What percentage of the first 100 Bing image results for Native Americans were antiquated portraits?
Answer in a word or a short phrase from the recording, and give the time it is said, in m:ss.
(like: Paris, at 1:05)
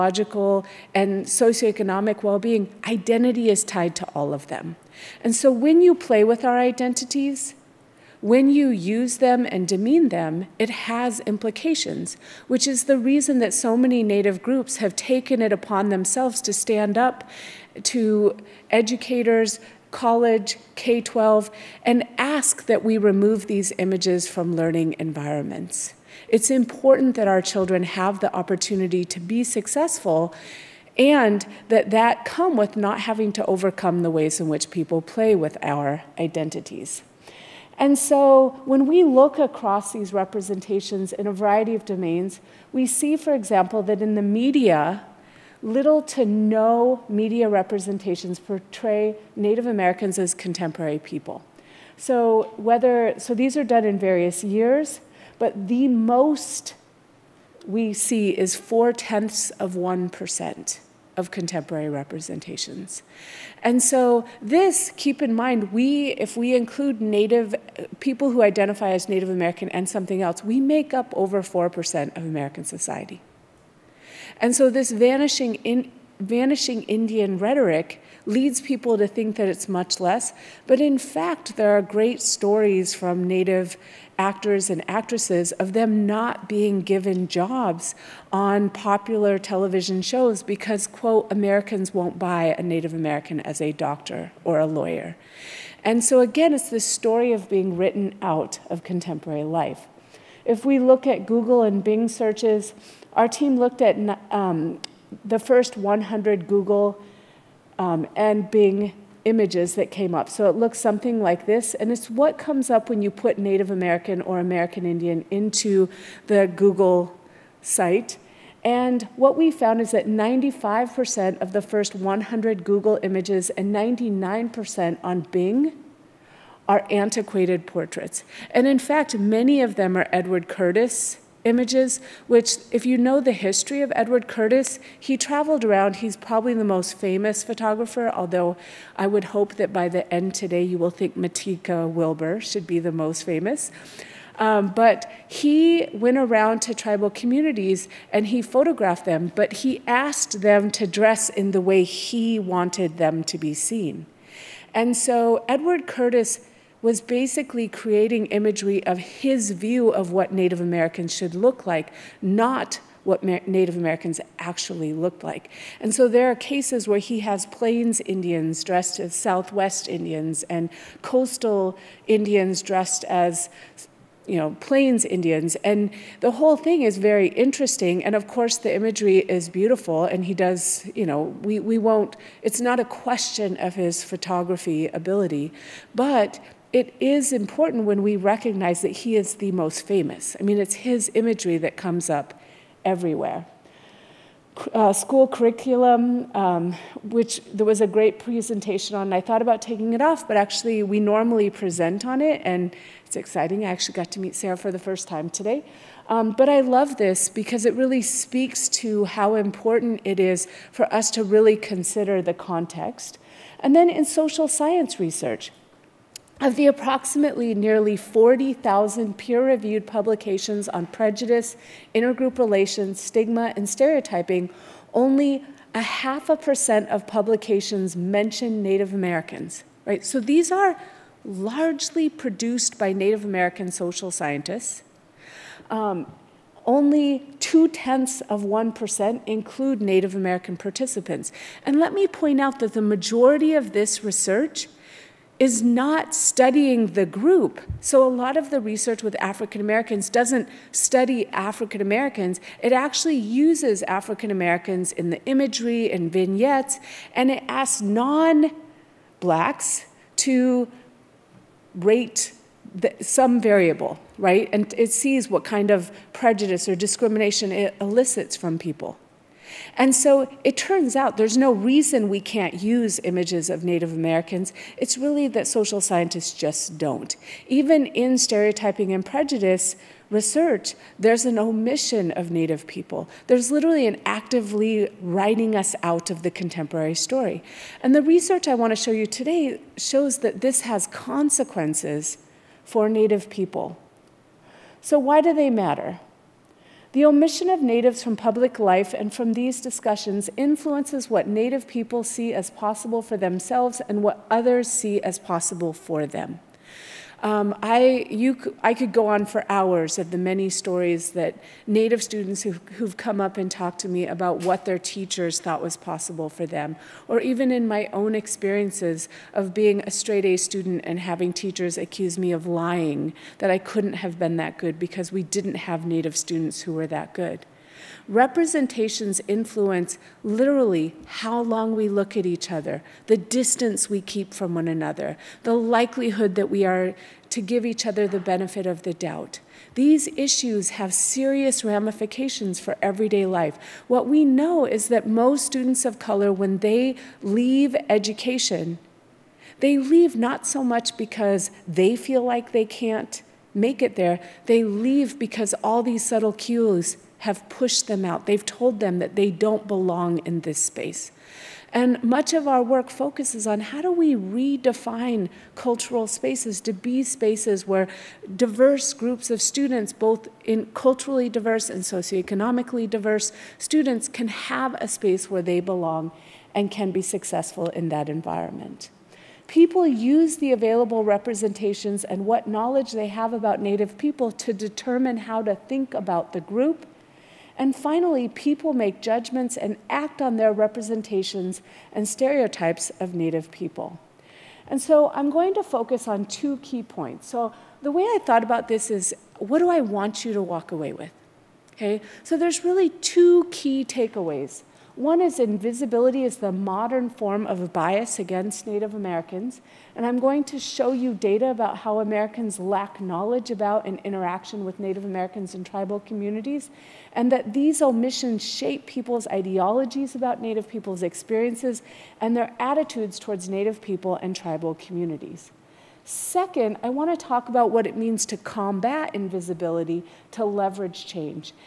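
99%, at 2:03.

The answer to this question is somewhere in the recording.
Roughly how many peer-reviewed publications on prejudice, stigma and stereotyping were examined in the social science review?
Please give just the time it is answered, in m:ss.
3:37.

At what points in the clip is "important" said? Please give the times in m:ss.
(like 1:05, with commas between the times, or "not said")
0:26, 3:07, 3:29.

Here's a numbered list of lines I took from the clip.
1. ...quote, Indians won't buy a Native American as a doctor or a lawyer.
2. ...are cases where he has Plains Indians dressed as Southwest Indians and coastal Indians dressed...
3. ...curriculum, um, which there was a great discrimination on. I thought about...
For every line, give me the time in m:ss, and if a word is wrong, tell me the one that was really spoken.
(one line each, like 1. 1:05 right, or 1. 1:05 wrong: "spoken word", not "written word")
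1. 1:30 wrong: "Americans", not "Indians"
2. 2:46 right
3. 3:15 wrong: "presentation", not "discrimination".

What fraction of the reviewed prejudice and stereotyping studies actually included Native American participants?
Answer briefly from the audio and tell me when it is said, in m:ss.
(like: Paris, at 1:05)
0.2%, at 3:57.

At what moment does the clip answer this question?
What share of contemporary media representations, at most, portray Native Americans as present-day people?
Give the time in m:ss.
0:58.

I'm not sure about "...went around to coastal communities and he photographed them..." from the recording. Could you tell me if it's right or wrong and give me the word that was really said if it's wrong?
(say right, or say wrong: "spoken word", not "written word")
wrong: "tribal", not "coastal".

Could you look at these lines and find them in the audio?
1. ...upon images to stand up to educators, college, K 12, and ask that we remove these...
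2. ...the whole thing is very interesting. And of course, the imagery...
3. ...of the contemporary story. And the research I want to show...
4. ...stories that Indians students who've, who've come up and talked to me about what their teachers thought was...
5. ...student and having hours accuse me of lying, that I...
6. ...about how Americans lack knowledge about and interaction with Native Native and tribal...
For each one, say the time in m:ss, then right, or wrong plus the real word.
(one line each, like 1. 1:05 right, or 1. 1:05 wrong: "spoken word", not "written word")
1. 0:15 wrong: "themselves", not "images"
2. 2:56 right
3. 4:46 right
4. 5:10 wrong: "Native", not "Indians"
5. 5:20 wrong: "teachers", not "hours"
6. 6:51 wrong: "Americans", not "Native".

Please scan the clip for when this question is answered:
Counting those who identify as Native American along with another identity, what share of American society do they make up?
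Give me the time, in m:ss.
1:11.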